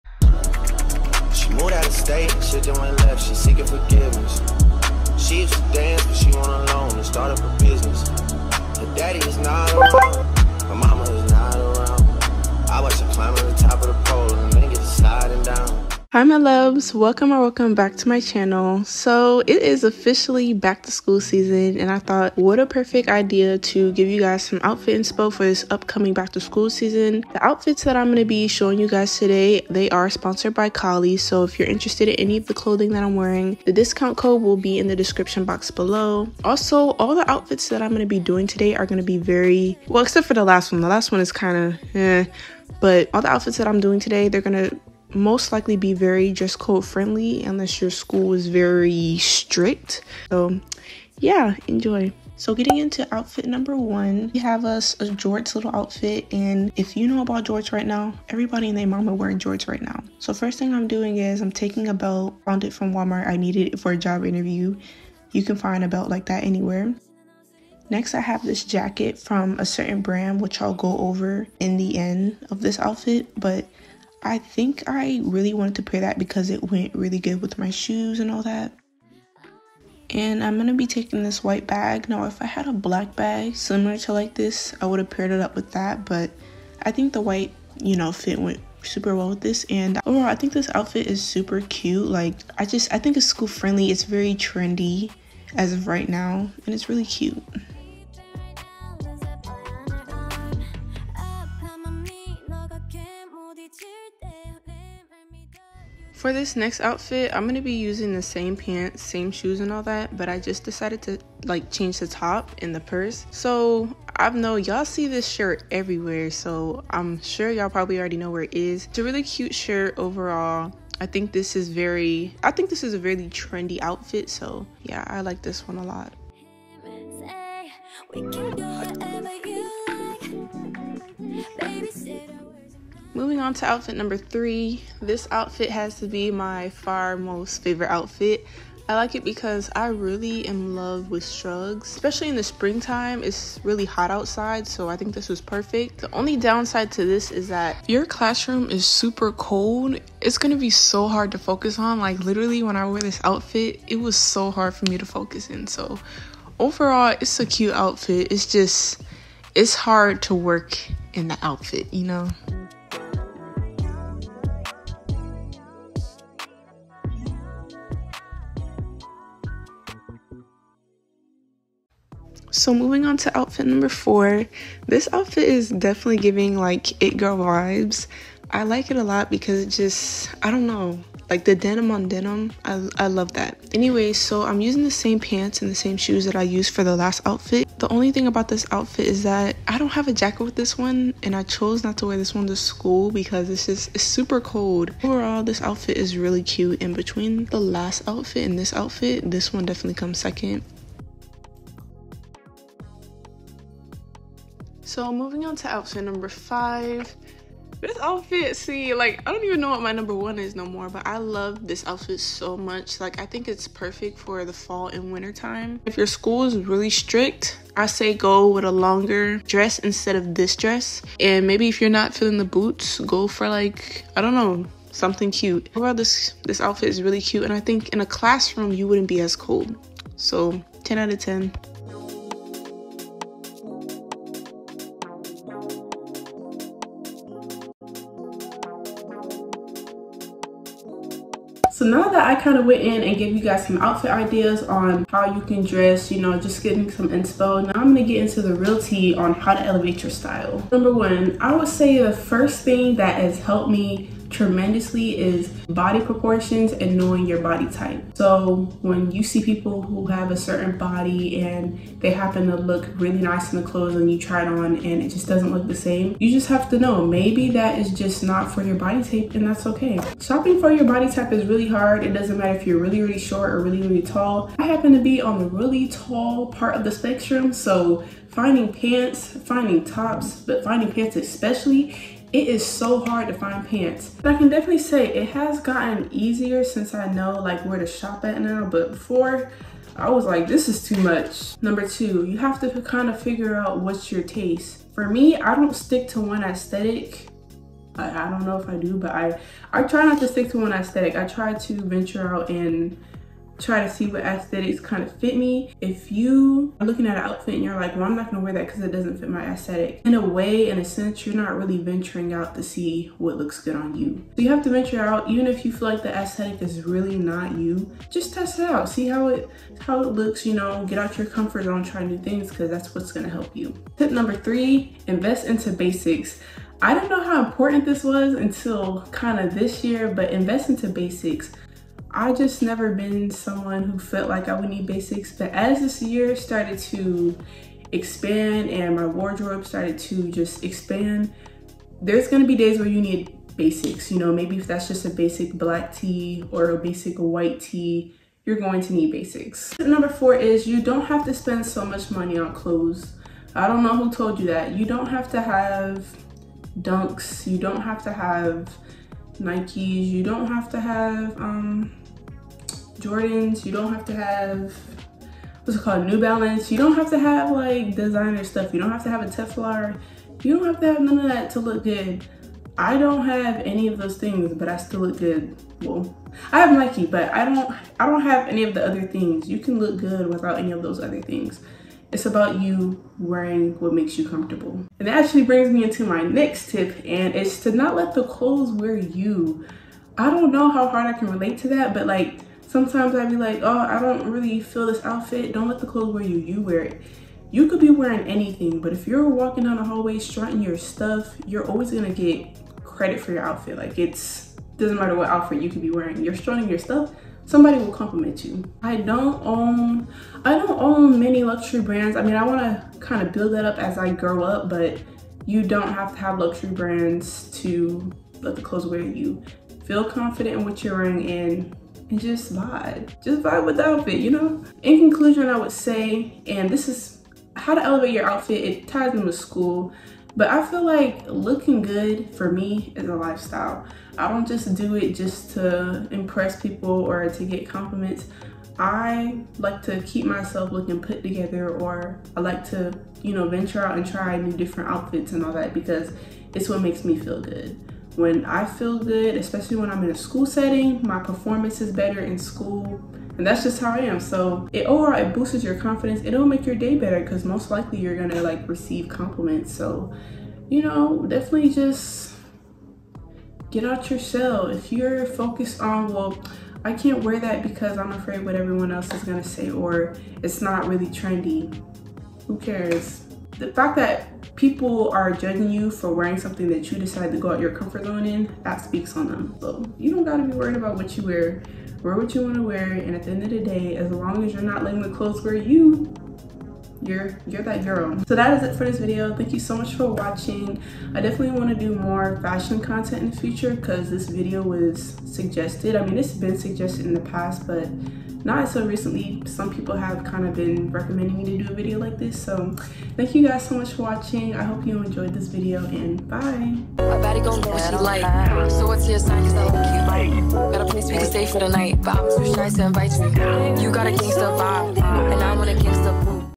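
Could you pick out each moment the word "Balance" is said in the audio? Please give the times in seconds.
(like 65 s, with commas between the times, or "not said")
366 s.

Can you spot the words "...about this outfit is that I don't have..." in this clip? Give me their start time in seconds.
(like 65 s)
188 s.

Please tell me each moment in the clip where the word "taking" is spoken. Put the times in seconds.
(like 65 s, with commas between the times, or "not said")
61 s, 80 s.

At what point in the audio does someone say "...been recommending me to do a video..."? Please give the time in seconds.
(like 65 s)
500 s.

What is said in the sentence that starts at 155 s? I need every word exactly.
So, overall, it's a cute outfit.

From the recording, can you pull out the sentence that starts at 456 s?
It'll make your day better because most likely you're gonna like receive compliments.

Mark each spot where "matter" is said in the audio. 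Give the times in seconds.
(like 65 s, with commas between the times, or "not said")
272 s, 404 s.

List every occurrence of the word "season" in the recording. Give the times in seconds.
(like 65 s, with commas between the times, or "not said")
21 s, 26 s.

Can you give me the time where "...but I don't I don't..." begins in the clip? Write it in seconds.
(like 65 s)
377 s.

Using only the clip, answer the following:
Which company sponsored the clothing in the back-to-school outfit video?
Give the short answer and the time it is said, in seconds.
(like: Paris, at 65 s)
Kollyy, at 30 s.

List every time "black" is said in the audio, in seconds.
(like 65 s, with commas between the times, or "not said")
82 s, 345 s.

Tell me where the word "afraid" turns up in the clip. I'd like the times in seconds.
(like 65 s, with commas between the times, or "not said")
468 s.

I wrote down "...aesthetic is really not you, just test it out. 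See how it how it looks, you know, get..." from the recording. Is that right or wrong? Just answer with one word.
right.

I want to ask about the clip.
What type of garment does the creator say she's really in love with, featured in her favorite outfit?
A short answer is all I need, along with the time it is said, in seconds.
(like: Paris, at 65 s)
Shrugs, at 141 s.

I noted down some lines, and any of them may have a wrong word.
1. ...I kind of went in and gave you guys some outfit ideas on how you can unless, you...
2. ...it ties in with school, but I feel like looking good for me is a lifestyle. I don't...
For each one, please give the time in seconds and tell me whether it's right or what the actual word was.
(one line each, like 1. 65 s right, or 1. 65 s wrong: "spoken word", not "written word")
1. 242 s wrong: "dress", not "unless"
2. 428 s right.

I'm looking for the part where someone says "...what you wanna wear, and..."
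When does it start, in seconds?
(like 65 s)
482 s.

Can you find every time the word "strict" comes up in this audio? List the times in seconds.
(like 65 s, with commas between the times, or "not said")
49 s, 216 s.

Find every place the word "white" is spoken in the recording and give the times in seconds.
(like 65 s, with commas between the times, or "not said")
81 s, 87 s, 347 s.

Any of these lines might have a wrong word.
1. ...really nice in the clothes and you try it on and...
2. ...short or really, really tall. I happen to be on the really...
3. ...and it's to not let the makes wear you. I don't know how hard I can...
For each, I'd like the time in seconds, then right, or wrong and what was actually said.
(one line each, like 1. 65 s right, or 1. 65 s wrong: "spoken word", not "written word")
1. 262 s right
2. 273 s right
3. 387 s wrong: "clothes", not "makes".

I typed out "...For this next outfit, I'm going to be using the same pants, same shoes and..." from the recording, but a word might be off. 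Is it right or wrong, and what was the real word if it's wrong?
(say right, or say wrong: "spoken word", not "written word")
right.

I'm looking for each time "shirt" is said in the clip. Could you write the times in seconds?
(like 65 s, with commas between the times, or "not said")
115 s, 119 s.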